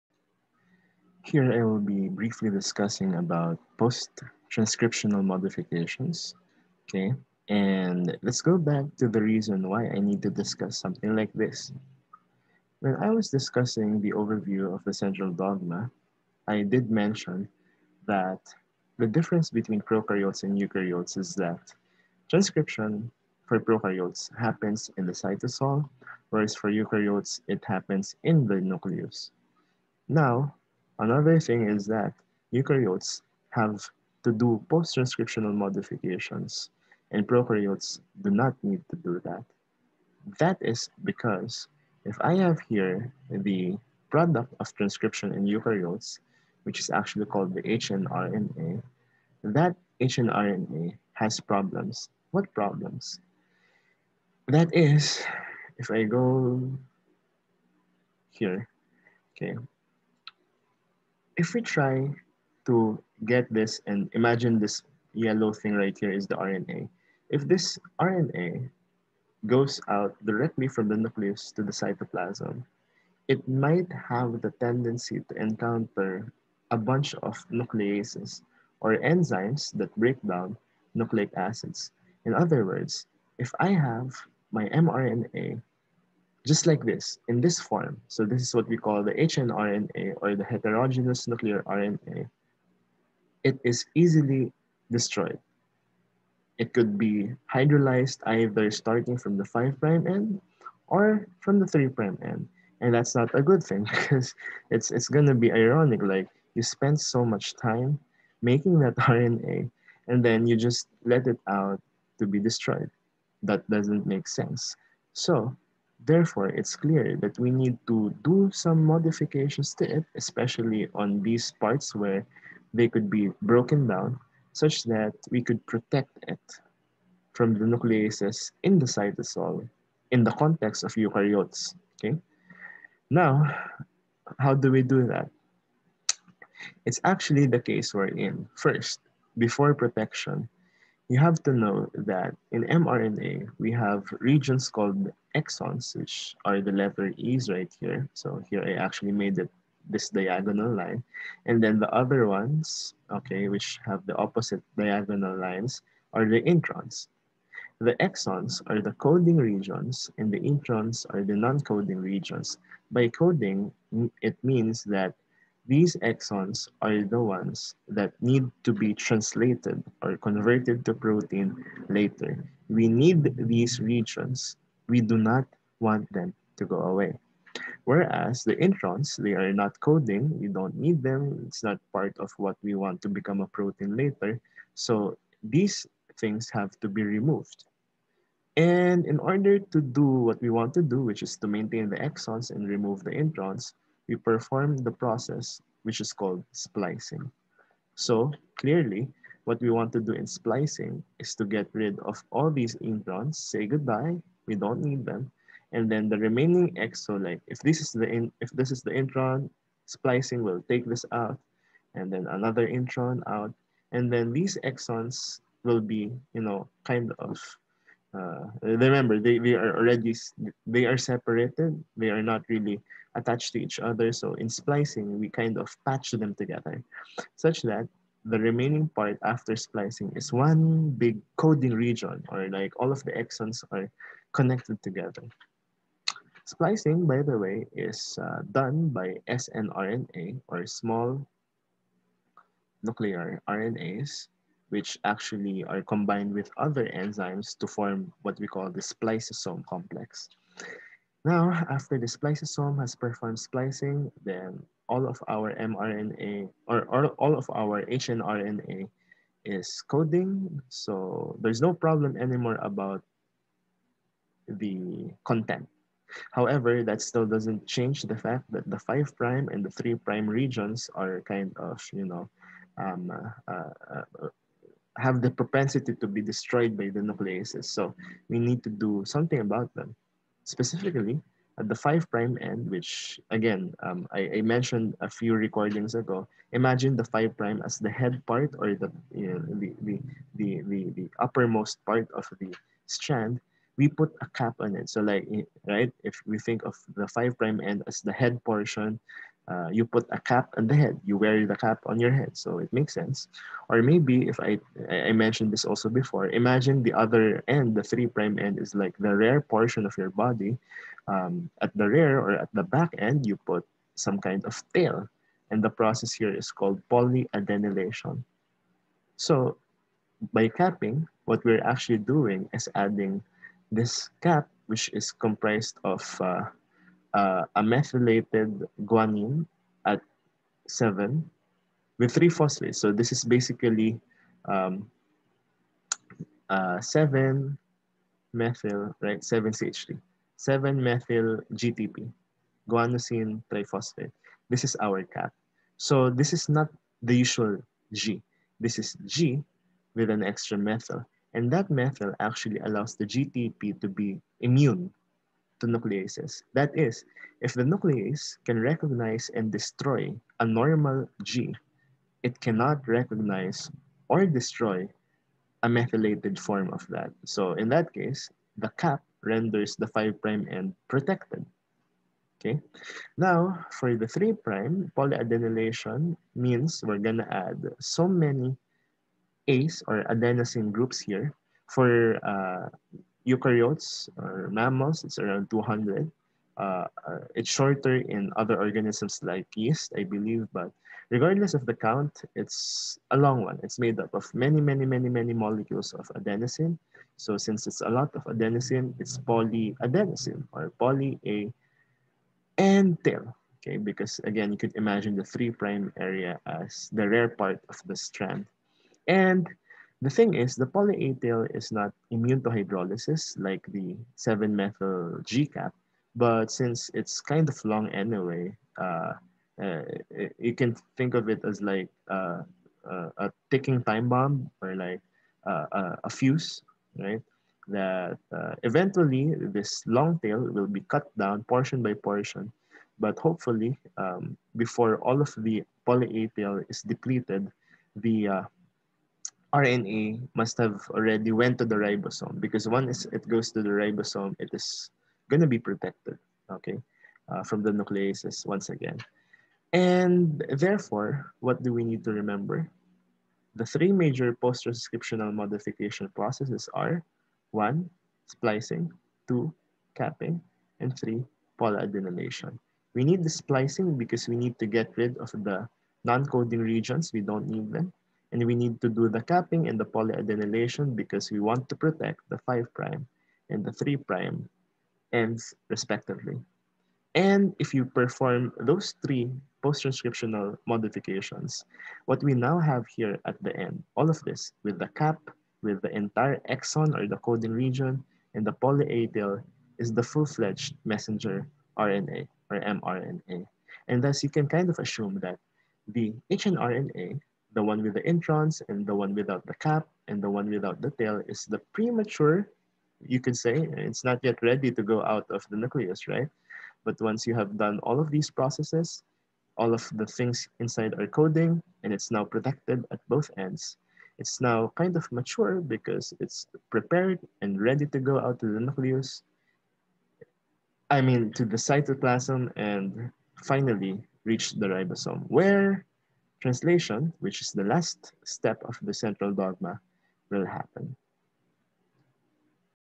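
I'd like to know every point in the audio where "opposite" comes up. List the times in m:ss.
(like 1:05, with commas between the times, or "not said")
2:34.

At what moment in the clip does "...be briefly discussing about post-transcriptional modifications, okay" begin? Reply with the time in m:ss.
0:01.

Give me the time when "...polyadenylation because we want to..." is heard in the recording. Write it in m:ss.
7:49.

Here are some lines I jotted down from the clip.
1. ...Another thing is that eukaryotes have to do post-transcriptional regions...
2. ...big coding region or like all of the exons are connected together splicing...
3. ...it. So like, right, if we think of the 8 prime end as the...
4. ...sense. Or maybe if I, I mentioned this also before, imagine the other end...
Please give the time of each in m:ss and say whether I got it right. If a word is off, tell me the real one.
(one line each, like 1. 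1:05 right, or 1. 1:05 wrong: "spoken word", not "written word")
1. 0:31 wrong: "modifications", not "regions"
2. 3:50 right
3. 4:54 wrong: "5", not "8"
4. 5:02 right.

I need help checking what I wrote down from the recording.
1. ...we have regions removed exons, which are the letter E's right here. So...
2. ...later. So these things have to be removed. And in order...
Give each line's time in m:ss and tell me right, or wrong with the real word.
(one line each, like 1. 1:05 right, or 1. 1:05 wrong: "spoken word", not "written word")
1. 2:23 wrong: "called", not "removed"
2. 3:03 right.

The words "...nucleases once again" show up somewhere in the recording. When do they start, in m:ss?
7:27.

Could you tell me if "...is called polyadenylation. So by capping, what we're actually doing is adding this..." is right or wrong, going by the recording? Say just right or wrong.
right.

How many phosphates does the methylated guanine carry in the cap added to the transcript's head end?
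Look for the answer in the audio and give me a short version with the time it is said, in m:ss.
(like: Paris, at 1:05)
3, at 5:32.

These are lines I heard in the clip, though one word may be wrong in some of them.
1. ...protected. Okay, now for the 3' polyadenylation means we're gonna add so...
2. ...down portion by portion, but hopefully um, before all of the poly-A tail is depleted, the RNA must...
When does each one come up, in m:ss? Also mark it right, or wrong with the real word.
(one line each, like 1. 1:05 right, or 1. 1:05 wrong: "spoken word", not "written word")
1. 6:10 right
2. 7:11 right.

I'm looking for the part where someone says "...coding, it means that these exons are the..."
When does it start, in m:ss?
2:43.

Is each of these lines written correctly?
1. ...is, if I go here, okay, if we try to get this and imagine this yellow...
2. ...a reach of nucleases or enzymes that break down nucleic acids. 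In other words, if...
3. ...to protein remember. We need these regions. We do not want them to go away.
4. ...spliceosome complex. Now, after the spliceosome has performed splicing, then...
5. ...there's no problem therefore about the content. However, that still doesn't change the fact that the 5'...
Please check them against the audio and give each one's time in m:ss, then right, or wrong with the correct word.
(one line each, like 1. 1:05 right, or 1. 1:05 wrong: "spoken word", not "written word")
1. 0:54 right
2. 1:16 wrong: "bunch", not "reach"
3. 2:50 wrong: "later", not "remember"
4. 4:08 right
5. 4:21 wrong: "anymore", not "therefore".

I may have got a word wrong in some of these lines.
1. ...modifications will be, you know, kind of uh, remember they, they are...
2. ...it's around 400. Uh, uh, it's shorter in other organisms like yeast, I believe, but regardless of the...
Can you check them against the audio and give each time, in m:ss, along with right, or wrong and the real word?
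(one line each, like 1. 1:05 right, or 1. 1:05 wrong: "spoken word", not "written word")
1. 3:34 wrong: "exons", not "modifications"
2. 6:25 wrong: "200", not "400".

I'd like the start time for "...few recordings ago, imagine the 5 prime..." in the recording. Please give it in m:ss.
4:45.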